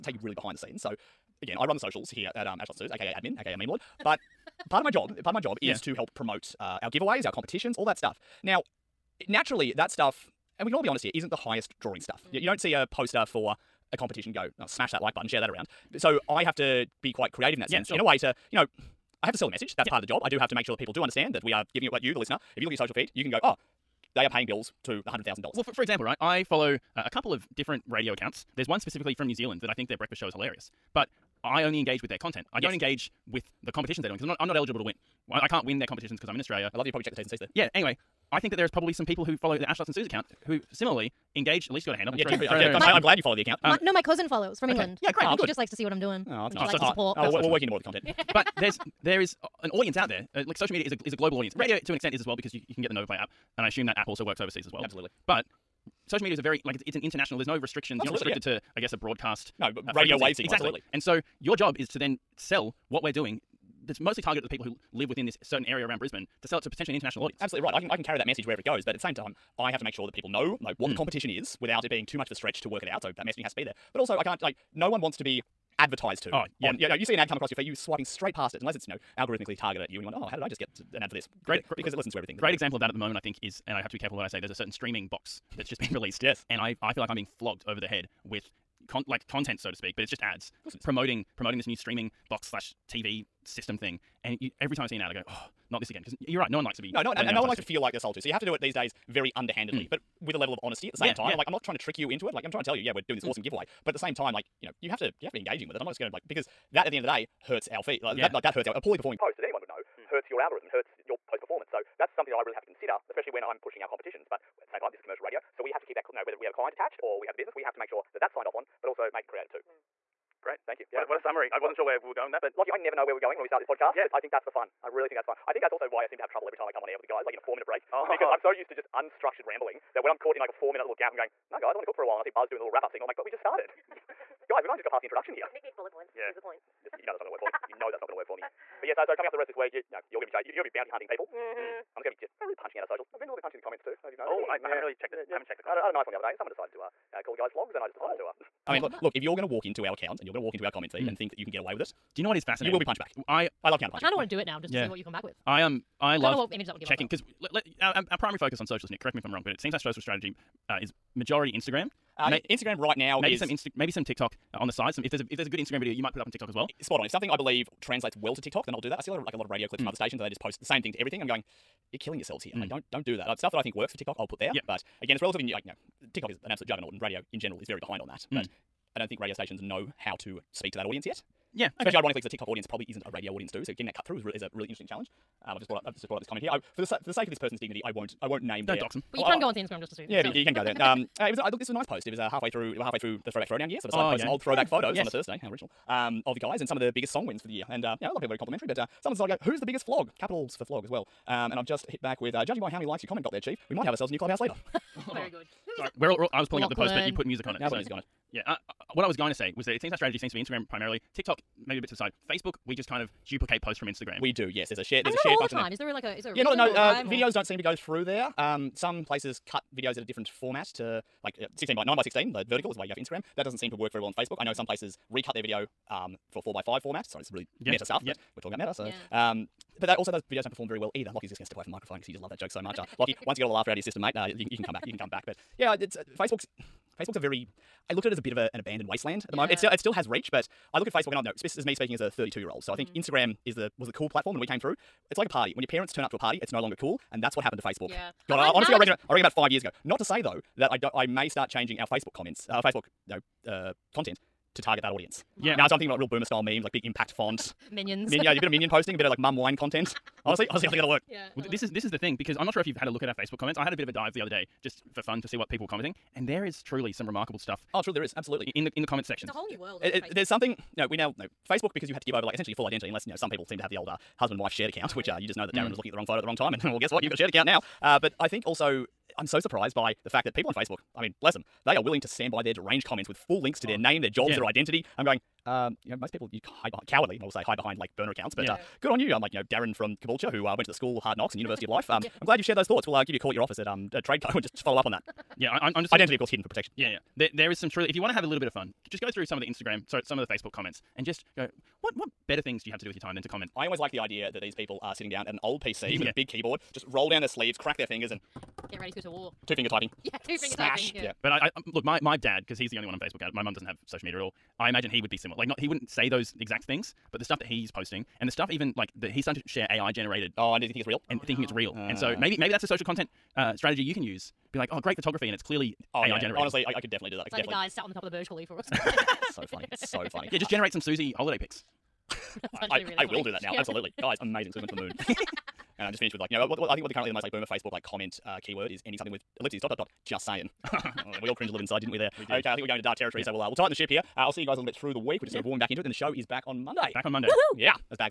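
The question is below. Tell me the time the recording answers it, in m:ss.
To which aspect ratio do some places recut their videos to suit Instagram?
3:46.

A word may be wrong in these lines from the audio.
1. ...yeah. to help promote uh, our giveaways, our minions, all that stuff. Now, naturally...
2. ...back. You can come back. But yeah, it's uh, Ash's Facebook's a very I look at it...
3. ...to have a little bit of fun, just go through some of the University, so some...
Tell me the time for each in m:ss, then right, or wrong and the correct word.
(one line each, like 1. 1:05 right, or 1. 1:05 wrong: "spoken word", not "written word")
1. 0:05 wrong: "competitions", not "minions"
2. 3:54 wrong: "Facebook", not "Ash"
3. 4:58 wrong: "Instagram", not "University".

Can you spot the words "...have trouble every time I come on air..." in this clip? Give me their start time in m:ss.
2:06.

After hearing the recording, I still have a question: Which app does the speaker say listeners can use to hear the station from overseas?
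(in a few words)
Nova Player.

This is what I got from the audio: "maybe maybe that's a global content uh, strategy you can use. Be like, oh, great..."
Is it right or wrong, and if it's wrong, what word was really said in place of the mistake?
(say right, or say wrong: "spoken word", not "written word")
wrong: "social", not "global".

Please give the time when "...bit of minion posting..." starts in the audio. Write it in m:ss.
4:18.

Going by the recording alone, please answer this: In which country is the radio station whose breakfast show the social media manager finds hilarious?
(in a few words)
New Zealand.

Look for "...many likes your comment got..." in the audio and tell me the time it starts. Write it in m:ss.
3:22.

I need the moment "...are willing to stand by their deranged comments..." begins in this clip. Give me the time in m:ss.
4:41.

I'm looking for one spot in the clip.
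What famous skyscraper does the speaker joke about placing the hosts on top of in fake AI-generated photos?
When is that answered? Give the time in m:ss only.
5:28.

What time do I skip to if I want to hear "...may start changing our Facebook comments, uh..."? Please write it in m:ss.
4:11.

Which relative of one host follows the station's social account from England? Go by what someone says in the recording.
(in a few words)
cousin.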